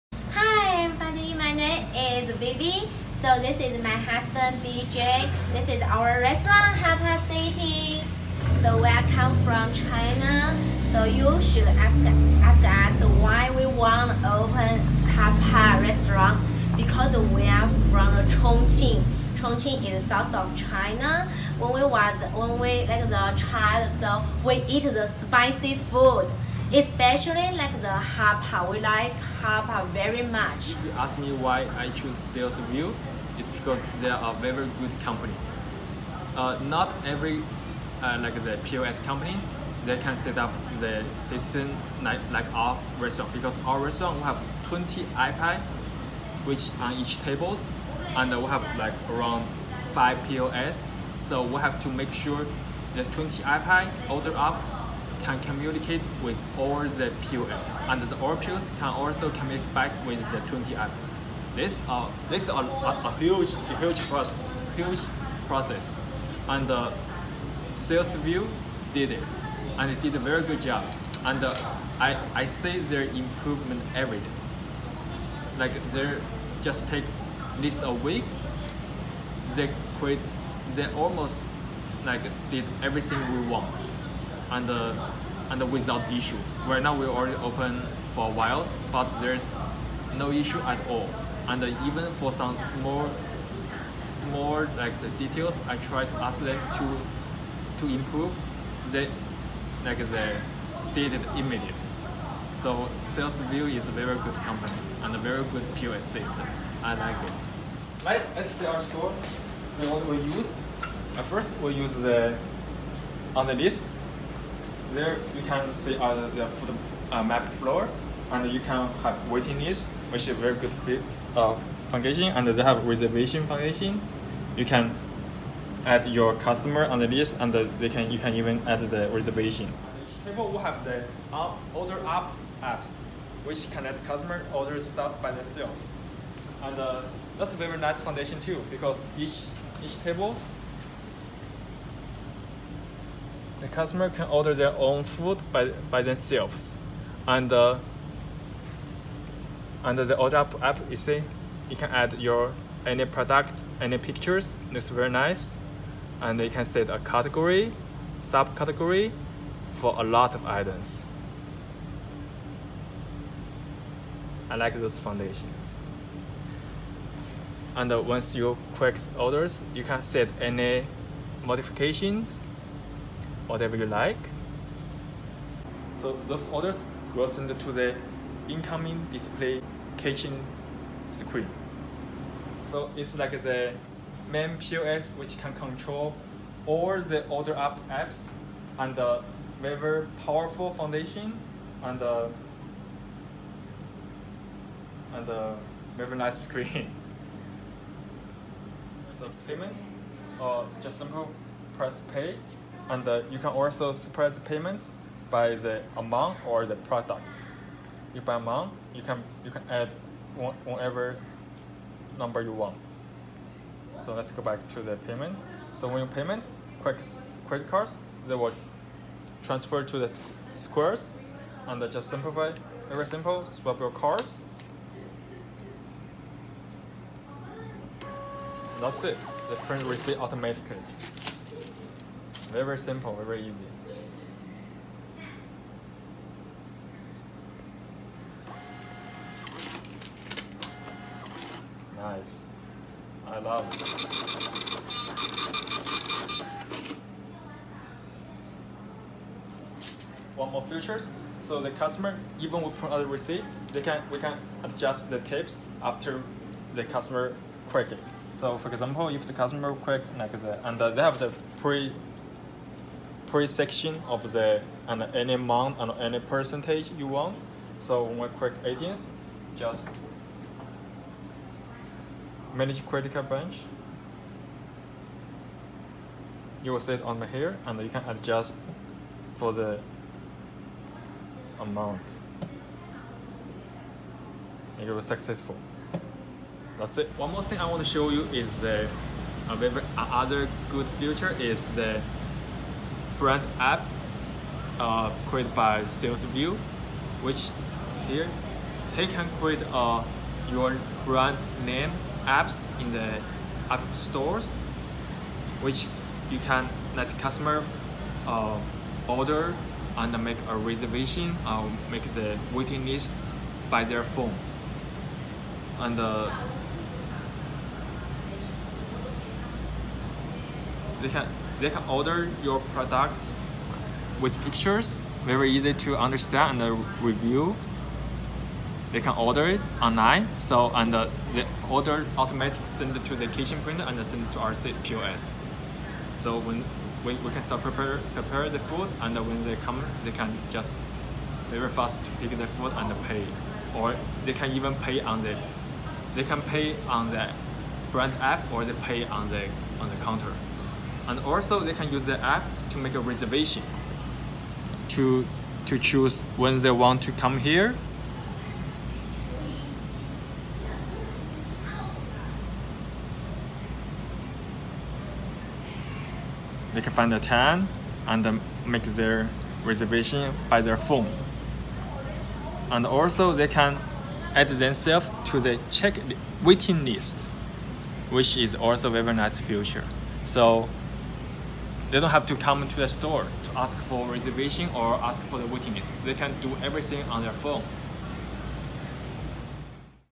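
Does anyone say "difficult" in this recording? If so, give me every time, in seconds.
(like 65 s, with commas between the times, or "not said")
not said.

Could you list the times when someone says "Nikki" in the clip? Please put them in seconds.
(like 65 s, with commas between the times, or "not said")
not said.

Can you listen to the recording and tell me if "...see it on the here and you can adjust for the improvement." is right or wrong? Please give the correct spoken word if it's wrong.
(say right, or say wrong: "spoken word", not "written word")
wrong: "amount", not "improvement".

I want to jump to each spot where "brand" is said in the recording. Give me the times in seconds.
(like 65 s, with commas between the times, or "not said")
293 s, 301 s, 347 s.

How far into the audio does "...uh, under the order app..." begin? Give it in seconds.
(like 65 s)
147 s.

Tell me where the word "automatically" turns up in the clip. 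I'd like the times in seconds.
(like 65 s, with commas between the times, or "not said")
230 s, 332 s.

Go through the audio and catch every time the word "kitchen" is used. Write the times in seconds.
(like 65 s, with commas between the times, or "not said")
179 s, 333 s.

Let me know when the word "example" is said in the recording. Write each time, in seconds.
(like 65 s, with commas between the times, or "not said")
258 s.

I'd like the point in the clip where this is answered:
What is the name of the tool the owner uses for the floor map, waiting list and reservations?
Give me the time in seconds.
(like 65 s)
113 s.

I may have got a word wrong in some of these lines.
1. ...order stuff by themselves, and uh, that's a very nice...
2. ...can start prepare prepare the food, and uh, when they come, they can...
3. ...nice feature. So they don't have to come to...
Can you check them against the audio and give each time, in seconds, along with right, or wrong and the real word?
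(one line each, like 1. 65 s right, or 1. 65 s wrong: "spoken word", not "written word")
1. 134 s right
2. 337 s right
3. 379 s right.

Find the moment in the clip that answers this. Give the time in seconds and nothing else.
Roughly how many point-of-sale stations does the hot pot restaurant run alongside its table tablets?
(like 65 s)
49 s.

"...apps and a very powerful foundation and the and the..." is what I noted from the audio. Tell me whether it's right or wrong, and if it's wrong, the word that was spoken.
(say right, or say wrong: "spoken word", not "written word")
right.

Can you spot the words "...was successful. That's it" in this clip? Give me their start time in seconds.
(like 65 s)
284 s.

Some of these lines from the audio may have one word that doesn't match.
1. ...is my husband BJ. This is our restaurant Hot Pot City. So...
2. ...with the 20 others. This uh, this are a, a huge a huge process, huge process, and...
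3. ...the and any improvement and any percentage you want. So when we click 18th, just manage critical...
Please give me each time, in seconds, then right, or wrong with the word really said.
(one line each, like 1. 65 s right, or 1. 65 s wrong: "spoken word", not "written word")
1. 3 s right
2. 60 s right
3. 264 s wrong: "amount", not "improvement".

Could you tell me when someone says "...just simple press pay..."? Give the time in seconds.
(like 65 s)
200 s.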